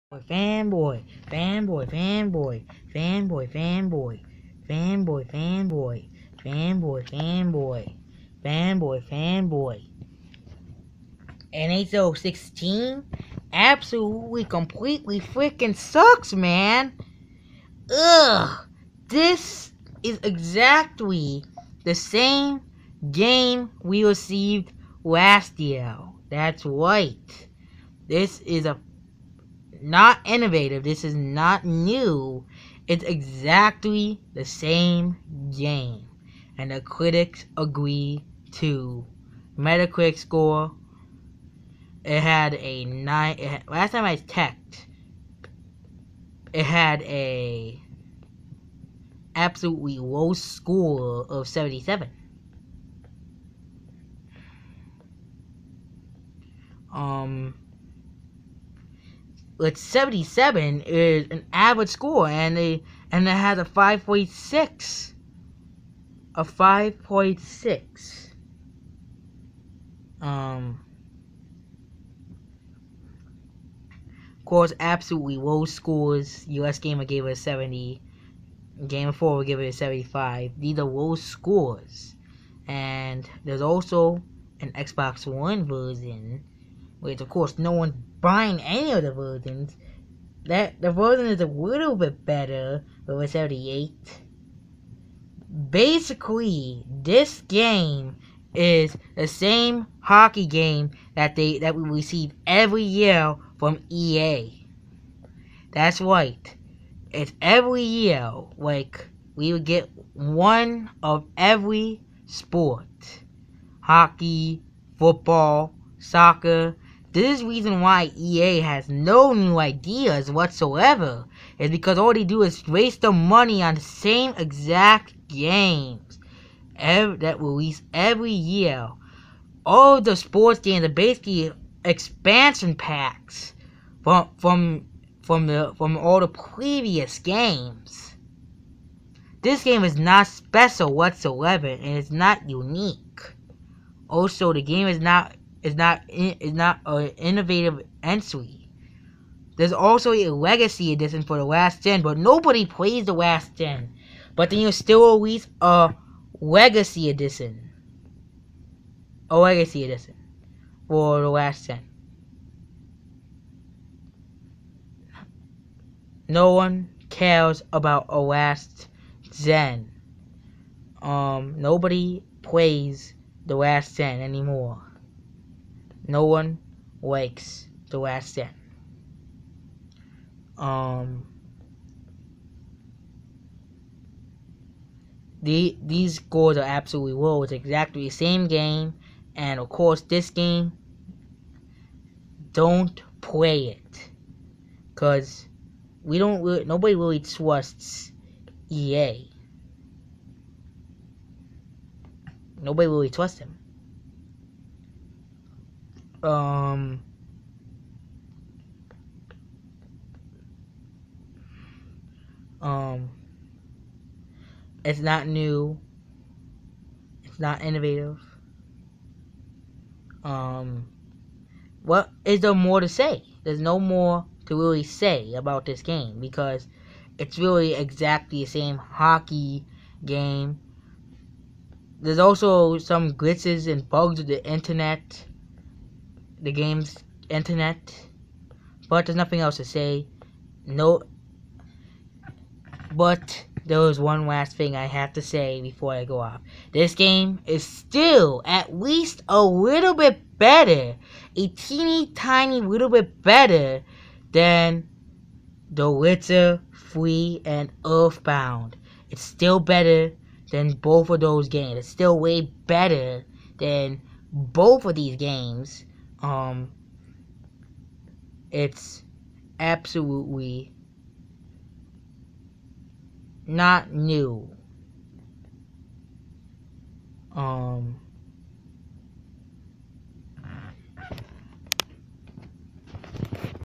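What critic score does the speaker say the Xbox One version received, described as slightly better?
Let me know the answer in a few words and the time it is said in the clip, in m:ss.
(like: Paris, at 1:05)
78, at 1:33.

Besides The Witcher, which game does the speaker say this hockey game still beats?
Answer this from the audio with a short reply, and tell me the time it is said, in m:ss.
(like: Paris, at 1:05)
Earthbound, at 4:17.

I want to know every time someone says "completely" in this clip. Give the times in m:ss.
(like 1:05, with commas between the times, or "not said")
0:14.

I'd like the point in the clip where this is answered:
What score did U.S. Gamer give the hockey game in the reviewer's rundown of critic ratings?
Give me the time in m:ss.
1:16.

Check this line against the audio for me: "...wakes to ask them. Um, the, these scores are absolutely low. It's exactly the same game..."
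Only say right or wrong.
right.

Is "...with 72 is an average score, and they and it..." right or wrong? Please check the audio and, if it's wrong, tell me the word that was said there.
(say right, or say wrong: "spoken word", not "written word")
wrong: "77", not "72".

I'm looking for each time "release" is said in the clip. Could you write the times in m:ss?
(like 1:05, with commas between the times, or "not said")
2:07, 2:35.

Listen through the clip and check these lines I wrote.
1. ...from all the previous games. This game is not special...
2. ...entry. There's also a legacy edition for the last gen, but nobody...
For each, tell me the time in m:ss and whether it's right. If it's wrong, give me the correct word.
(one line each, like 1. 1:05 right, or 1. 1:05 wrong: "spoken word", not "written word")
1. 2:15 right
2. 2:28 right.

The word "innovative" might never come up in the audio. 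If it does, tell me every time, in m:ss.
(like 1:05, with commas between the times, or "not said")
0:30, 2:27, 3:37.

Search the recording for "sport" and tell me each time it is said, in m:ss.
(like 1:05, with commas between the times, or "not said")
1:52, 2:10.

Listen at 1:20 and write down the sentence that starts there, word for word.
These are low scores, and there's also an Xbox One version which of course no one's buying any of the versions.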